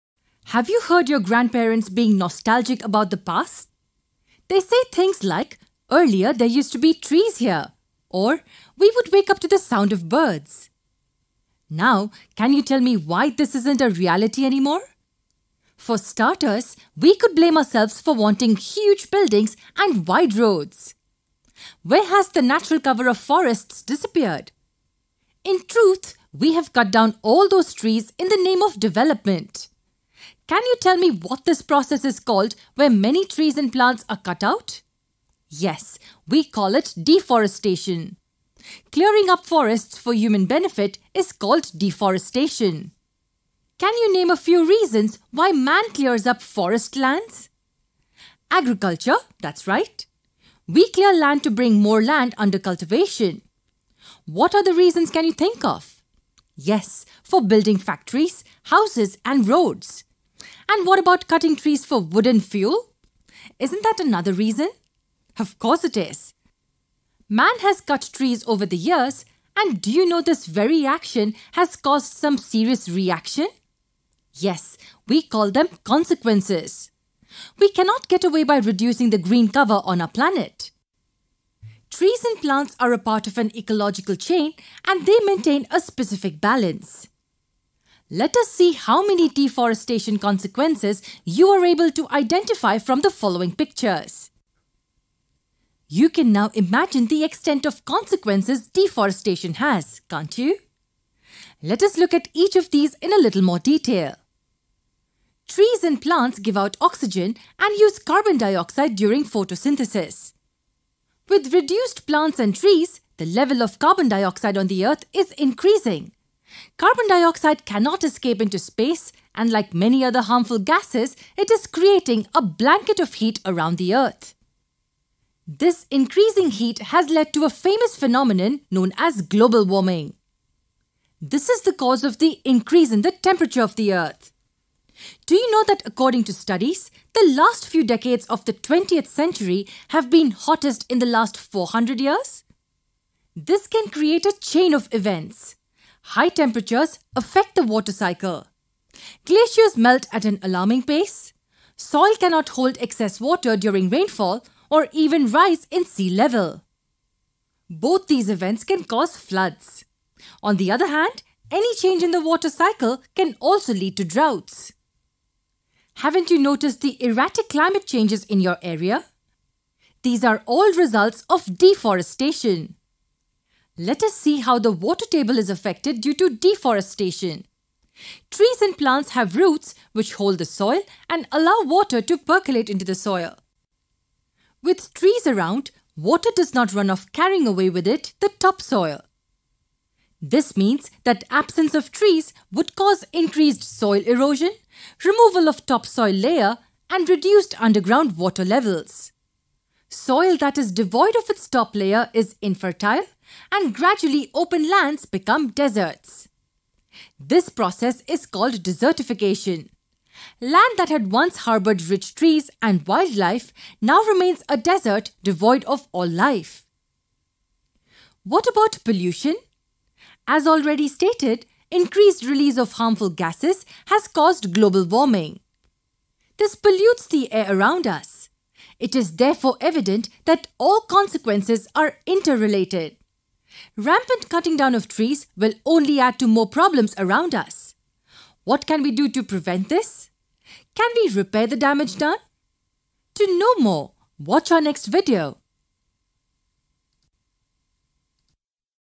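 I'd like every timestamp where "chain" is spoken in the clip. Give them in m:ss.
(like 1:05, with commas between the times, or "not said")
1:24, 2:24.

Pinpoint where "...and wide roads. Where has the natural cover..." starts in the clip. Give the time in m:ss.
0:19.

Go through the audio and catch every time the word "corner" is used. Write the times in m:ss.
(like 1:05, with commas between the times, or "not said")
not said.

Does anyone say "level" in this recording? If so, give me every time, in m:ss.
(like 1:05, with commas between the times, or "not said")
1:53, 2:36, 3:18.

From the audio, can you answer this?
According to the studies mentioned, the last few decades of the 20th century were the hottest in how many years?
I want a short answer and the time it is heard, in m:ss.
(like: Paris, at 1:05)
400 years, at 2:21.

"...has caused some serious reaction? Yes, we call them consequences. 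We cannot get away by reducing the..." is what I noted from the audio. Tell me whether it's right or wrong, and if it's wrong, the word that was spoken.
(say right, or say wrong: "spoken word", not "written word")
right.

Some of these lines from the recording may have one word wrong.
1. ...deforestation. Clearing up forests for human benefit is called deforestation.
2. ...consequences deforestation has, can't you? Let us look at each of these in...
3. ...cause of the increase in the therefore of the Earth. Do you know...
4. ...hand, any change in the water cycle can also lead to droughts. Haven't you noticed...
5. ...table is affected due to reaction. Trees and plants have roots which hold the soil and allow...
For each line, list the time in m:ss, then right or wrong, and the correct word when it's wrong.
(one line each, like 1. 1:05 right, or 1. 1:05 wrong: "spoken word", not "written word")
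1. 0:37 right
2. 1:37 right
3. 2:11 wrong: "temperature", not "therefore"
4. 2:40 right
5. 2:55 wrong: "deforestation", not "reaction".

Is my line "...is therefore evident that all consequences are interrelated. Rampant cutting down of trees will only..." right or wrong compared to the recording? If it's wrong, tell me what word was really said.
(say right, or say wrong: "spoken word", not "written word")
right.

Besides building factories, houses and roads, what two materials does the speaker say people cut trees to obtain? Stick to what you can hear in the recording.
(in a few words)
wood and fuel.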